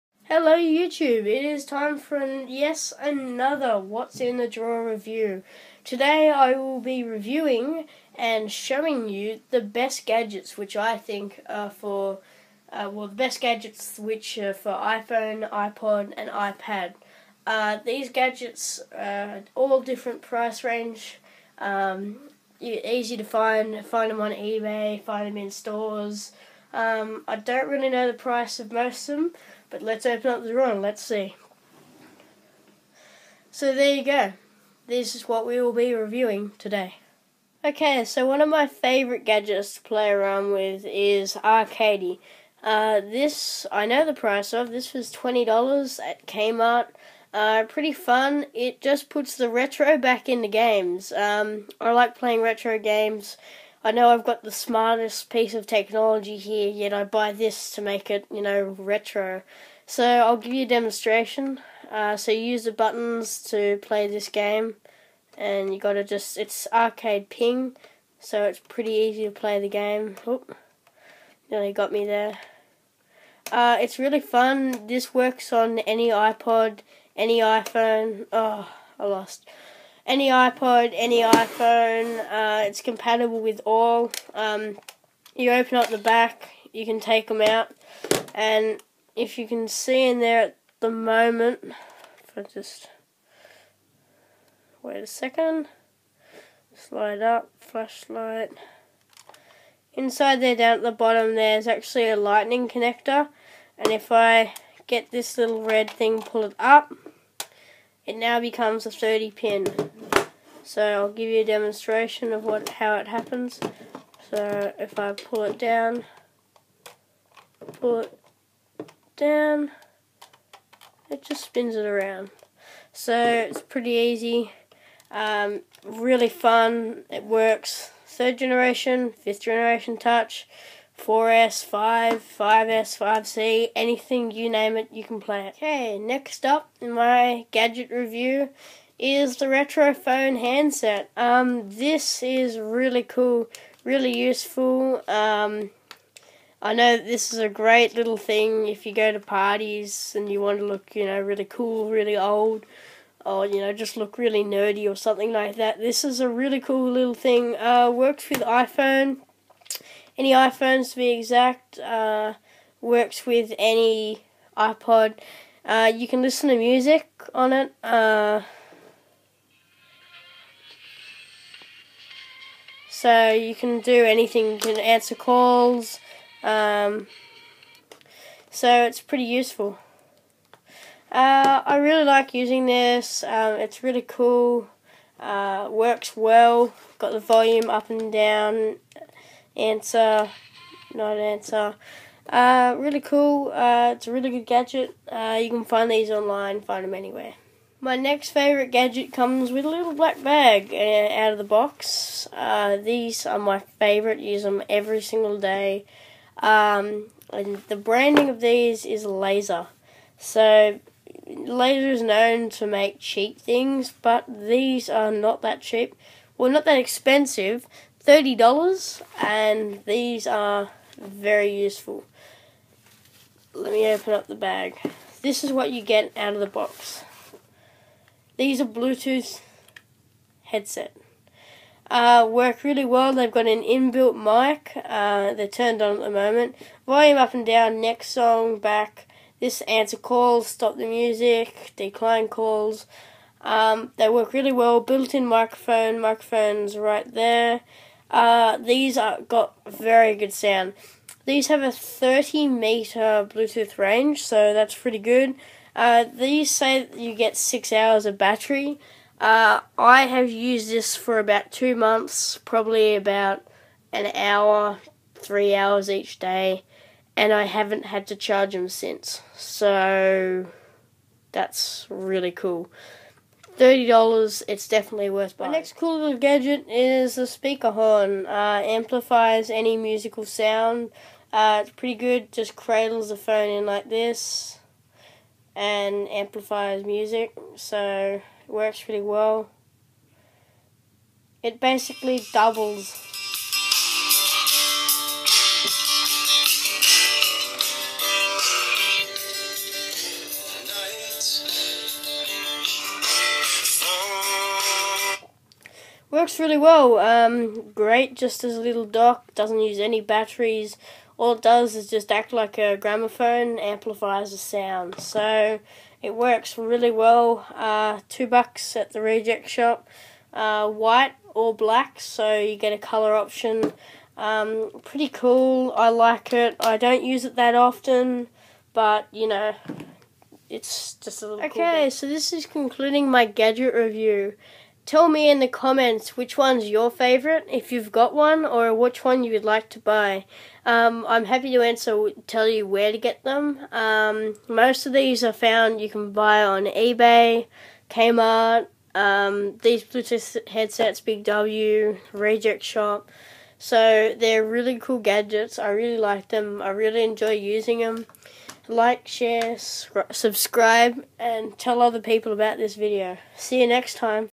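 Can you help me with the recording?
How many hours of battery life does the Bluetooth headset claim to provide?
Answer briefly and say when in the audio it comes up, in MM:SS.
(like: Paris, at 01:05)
6 hours, at 04:17.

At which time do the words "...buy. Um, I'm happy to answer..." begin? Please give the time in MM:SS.
05:39.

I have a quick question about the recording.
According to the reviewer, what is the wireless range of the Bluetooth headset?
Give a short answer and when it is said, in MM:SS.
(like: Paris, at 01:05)
30 meters, at 04:11.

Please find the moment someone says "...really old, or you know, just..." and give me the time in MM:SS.
02:31.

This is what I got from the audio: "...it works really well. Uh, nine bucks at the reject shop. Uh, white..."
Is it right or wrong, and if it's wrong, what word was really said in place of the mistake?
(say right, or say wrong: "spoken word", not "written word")
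wrong: "two", not "nine".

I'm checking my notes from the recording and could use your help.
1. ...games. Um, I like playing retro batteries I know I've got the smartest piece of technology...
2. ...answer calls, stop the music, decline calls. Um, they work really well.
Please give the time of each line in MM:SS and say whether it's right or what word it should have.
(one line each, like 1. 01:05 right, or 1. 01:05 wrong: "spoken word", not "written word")
1. 00:50 wrong: "games", not "batteries"
2. 03:59 right.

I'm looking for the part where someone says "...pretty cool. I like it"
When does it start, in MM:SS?
05:24.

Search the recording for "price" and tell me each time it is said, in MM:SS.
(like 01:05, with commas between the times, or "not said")
00:20, 00:28, 00:44.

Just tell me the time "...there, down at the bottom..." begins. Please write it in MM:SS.
01:40.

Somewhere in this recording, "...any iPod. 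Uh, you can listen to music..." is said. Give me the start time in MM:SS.
02:43.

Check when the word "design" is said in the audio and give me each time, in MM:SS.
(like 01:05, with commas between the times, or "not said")
not said.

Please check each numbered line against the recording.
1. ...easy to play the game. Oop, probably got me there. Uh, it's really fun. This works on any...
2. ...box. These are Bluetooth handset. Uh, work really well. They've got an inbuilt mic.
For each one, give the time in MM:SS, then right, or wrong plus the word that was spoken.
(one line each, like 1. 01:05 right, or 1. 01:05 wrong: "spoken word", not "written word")
1. 01:08 wrong: "nearly", not "probably"
2. 03:46 wrong: "headset", not "handset".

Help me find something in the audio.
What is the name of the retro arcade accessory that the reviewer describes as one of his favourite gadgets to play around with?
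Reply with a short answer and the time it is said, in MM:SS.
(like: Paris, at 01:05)
Arcady, at 00:41.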